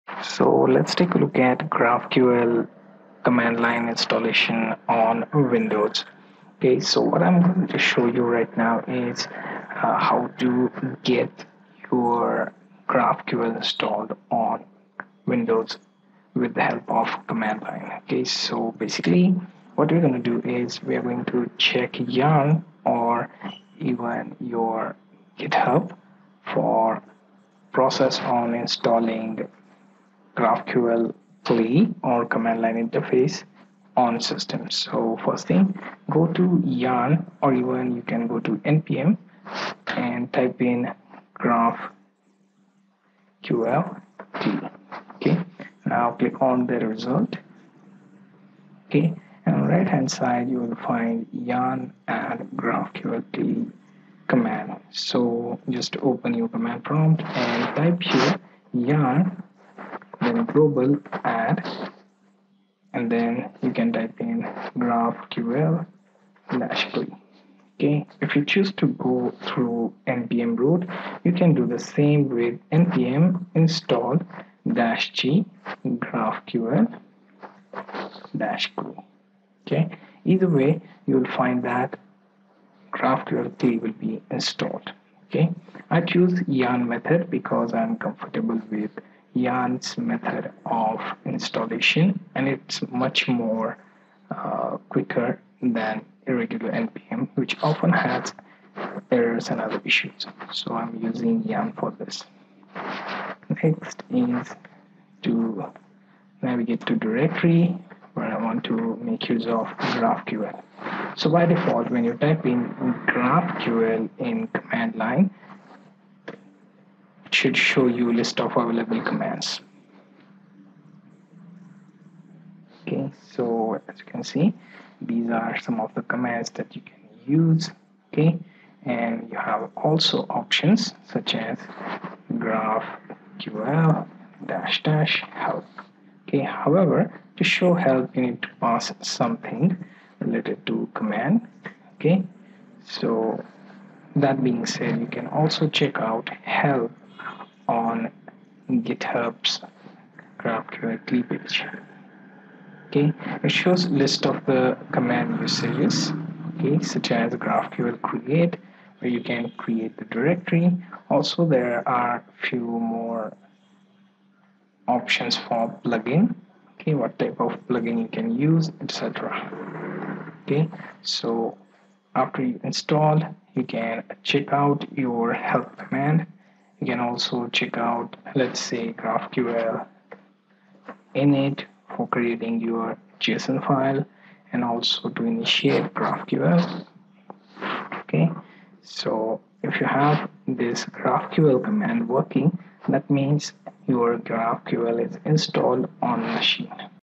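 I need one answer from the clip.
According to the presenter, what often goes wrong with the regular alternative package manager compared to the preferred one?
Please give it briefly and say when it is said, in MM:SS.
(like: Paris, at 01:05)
errors, at 01:39.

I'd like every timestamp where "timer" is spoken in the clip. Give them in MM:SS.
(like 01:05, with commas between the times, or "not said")
not said.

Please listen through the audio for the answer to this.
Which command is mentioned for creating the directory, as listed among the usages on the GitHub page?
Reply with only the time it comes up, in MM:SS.
02:37.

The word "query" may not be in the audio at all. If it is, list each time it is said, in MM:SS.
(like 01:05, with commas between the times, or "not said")
01:06, 01:18.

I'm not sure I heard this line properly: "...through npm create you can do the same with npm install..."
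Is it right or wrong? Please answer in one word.
wrong.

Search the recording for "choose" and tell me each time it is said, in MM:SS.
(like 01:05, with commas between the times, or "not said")
01:08, 01:26.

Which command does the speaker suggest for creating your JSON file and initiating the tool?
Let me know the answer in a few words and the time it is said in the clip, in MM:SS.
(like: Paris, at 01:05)
GraphQL init, at 02:58.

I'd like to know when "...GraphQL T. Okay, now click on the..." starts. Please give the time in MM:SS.
00:41.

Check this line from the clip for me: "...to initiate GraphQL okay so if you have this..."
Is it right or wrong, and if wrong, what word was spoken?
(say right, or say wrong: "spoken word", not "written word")
right.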